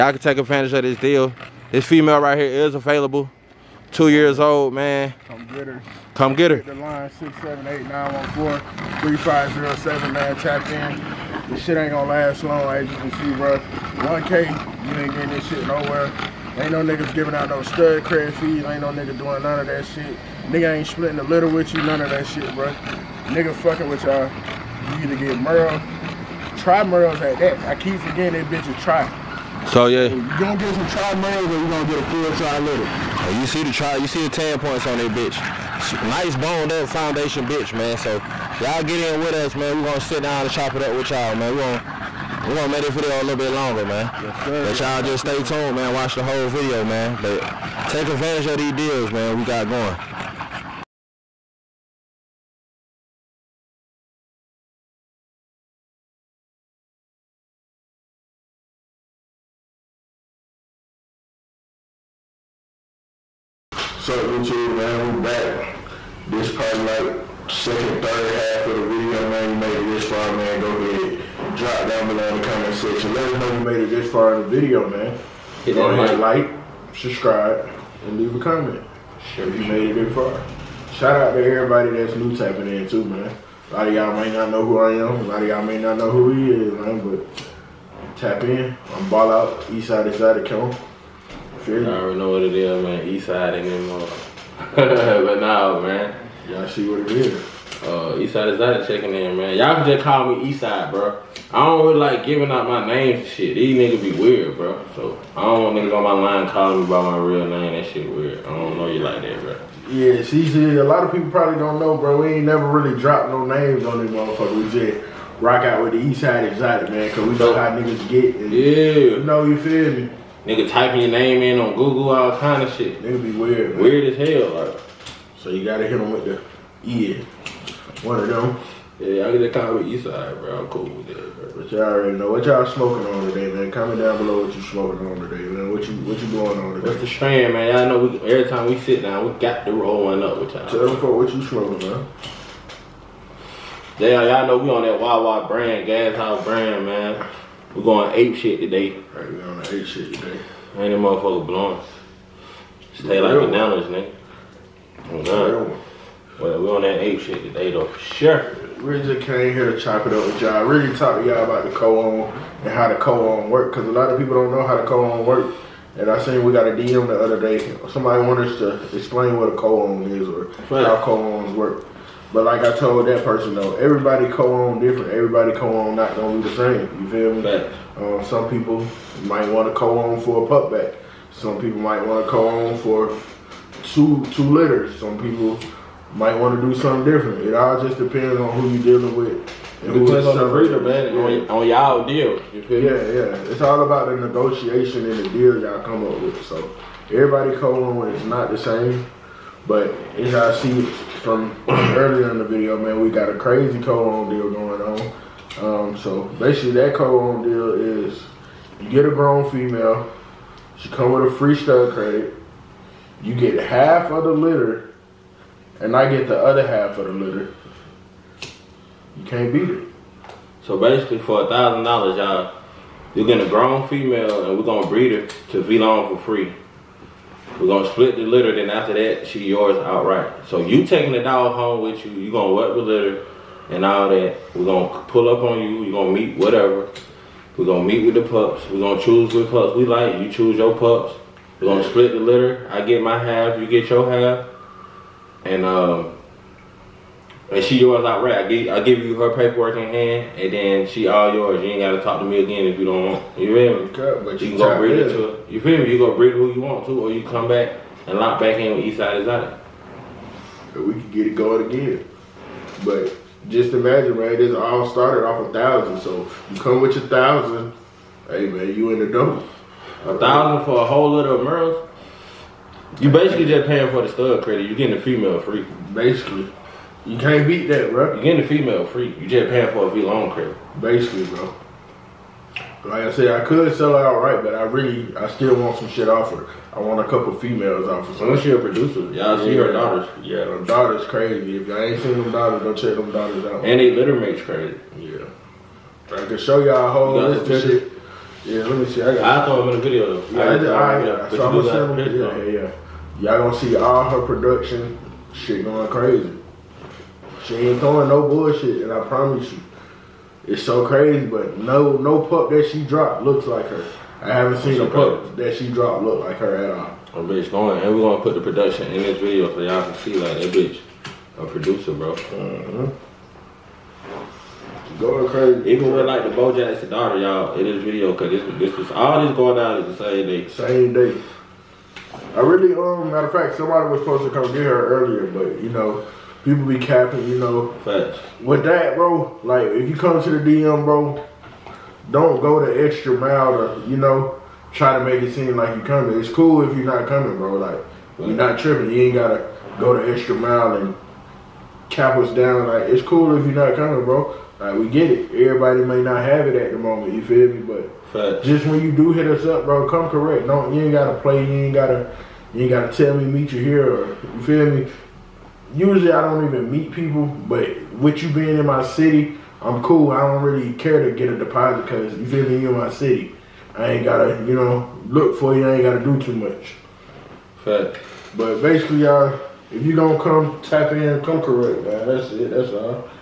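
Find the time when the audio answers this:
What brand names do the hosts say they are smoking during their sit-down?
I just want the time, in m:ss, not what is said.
2:24.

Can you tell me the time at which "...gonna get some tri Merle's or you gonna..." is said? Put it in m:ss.
0:30.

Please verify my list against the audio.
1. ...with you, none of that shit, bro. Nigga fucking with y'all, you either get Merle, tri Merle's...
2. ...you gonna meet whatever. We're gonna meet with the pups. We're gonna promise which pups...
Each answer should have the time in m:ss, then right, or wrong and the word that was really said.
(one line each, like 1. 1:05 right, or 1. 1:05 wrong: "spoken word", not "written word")
1. 0:21 right
2. 3:55 wrong: "choose", not "promise".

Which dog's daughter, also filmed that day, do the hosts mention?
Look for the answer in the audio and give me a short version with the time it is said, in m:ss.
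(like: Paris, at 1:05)
Bojack, at 5:26.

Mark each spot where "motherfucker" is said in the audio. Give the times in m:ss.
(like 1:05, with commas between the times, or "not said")
1:54, 2:30.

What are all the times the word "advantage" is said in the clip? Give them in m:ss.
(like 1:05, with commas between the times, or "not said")
0:00, 0:48.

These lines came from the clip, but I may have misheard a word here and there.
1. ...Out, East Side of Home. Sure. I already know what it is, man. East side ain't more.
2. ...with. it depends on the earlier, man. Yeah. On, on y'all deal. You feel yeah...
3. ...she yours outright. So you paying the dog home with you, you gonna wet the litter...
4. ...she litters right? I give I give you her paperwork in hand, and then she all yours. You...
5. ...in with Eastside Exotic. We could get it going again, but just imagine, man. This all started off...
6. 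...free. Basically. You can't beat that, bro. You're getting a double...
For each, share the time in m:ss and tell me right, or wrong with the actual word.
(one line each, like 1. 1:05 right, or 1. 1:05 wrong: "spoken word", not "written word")
1. 1:29 right
2. 3:09 wrong: "breeder", not "earlier"
3. 3:49 wrong: "taking", not "paying"
4. 4:07 wrong: "yours", not "litters"
5. 4:18 right
6. 4:35 wrong: "female", not "double".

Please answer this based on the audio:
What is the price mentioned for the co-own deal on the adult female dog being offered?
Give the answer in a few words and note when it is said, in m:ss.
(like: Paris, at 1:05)
1K, at 0:13.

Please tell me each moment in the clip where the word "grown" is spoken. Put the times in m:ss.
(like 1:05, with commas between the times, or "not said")
3:29, 3:43.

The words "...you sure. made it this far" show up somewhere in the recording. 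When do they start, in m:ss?
1:19.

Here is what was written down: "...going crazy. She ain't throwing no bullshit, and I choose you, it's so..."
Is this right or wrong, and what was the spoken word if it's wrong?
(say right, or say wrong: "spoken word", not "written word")
wrong: "promise", not "choose".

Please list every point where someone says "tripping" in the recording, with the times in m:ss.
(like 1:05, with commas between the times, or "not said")
5:48.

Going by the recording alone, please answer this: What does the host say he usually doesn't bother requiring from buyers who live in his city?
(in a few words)
a deposit.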